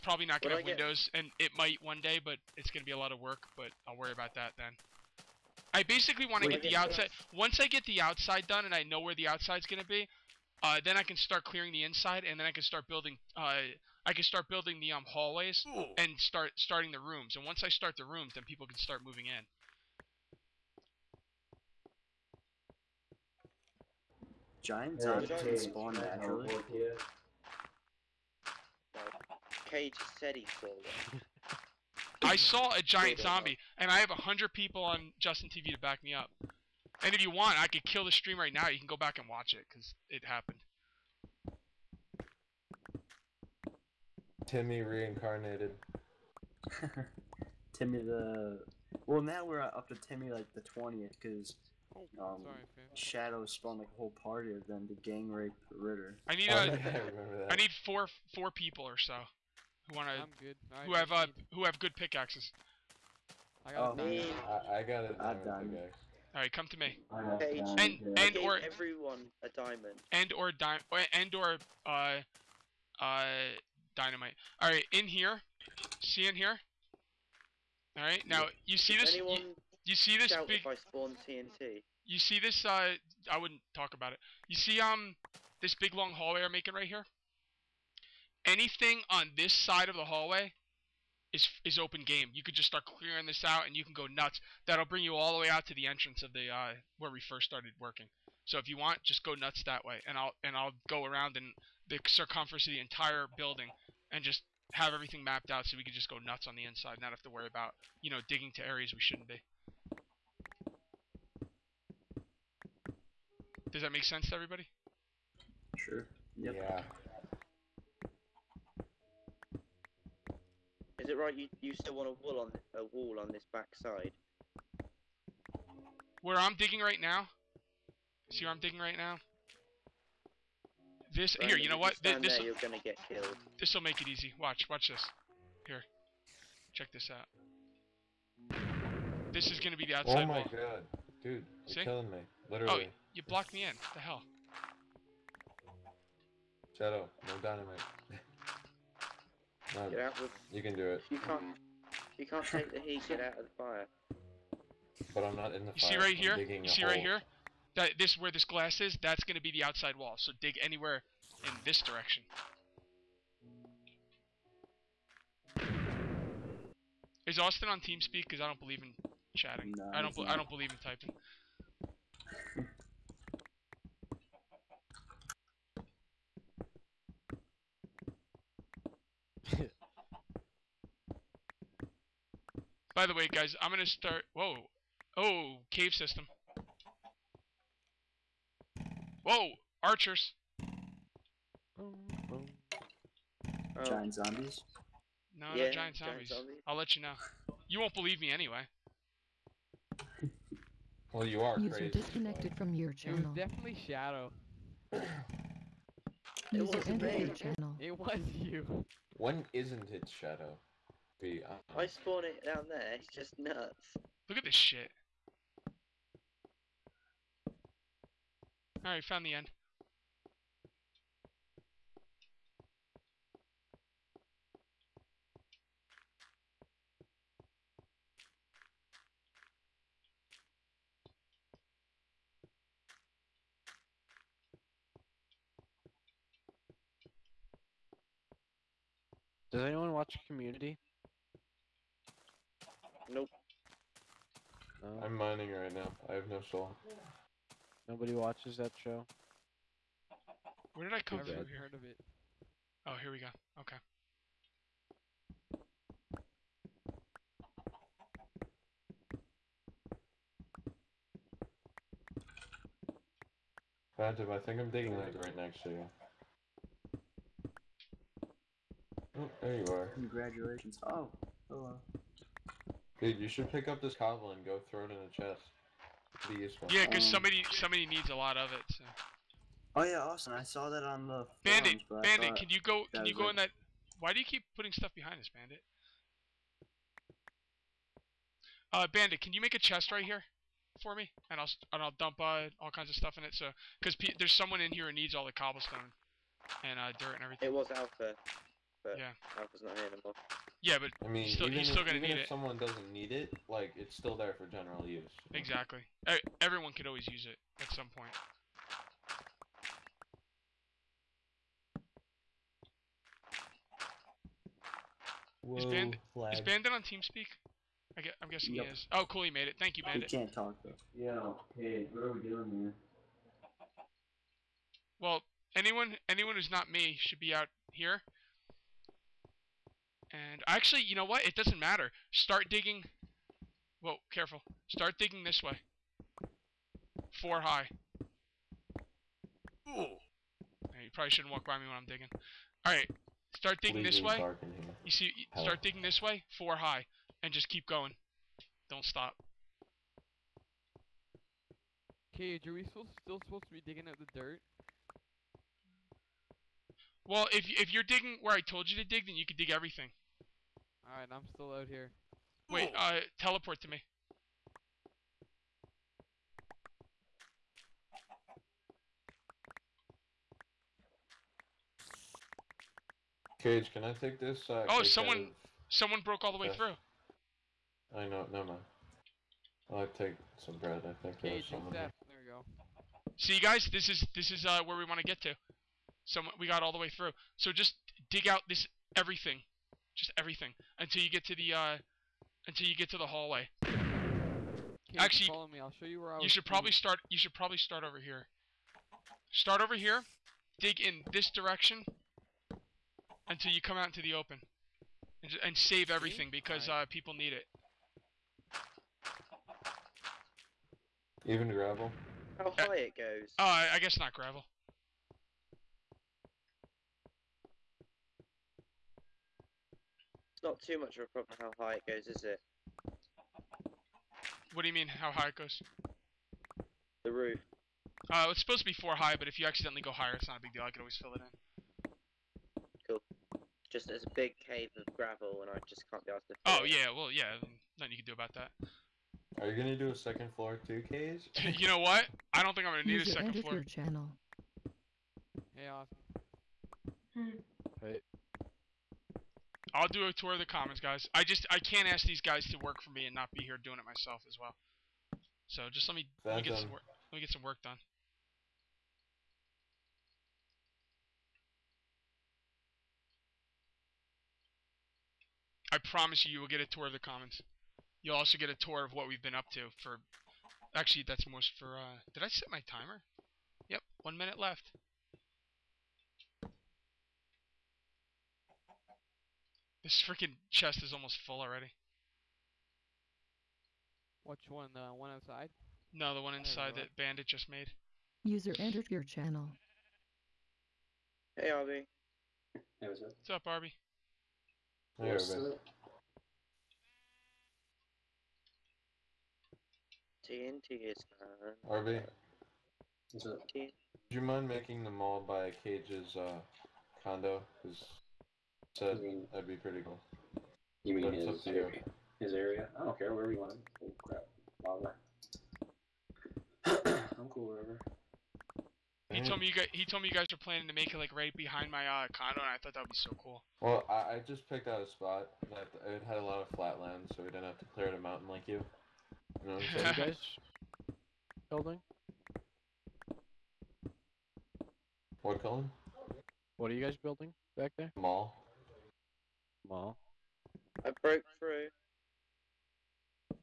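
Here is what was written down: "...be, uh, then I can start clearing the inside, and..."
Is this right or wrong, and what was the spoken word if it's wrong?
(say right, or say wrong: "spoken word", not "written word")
right.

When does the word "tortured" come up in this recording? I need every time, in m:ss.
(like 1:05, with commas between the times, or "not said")
not said.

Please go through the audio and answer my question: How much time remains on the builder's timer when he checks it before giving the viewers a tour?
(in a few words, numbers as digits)
One minute.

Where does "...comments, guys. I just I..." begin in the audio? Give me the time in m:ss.
7:30.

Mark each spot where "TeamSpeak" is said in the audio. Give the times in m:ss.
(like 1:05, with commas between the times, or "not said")
2:47, 5:16.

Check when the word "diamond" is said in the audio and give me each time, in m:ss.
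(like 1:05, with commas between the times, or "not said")
1:05, 1:09.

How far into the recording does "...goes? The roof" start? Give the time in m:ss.
7:05.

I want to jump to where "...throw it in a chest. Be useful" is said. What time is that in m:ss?
4:34.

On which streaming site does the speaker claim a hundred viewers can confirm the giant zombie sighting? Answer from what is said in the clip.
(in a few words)
Justin TV.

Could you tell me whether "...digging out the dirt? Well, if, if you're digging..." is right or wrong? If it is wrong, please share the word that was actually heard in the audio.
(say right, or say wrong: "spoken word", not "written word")
right.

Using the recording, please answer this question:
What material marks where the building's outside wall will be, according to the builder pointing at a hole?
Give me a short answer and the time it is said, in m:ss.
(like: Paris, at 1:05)
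Glass, at 2:38.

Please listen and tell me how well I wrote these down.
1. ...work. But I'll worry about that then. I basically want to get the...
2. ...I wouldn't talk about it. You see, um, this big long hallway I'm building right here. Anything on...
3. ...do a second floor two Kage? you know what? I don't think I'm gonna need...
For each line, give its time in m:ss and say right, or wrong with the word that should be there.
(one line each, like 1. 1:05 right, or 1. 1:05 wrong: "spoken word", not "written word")
1. 0:03 right
2. 1:23 wrong: "making", not "building"
3. 7:19 right.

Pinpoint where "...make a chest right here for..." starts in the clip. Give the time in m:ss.
4:49.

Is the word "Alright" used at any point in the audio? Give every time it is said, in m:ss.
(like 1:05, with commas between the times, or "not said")
3:38, 5:42, 6:00.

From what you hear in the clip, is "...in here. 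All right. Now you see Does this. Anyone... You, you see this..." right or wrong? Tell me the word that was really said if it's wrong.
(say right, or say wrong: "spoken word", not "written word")
right.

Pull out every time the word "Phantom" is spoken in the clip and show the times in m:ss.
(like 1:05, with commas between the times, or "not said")
4:23.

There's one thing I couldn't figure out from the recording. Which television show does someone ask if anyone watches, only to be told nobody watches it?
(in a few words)
Community.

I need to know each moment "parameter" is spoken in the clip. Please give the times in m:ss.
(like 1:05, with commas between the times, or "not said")
not said.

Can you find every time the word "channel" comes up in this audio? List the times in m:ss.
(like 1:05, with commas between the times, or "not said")
3:22, 3:27, 7:23, 8:09.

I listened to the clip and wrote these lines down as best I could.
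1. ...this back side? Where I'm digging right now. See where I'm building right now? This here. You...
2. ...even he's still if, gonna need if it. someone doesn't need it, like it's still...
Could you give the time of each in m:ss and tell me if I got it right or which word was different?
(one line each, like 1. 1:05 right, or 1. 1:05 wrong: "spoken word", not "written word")
1. 2:03 wrong: "digging", not "building"
2. 5:01 right.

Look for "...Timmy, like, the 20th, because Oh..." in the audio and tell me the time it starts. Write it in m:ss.
0:49.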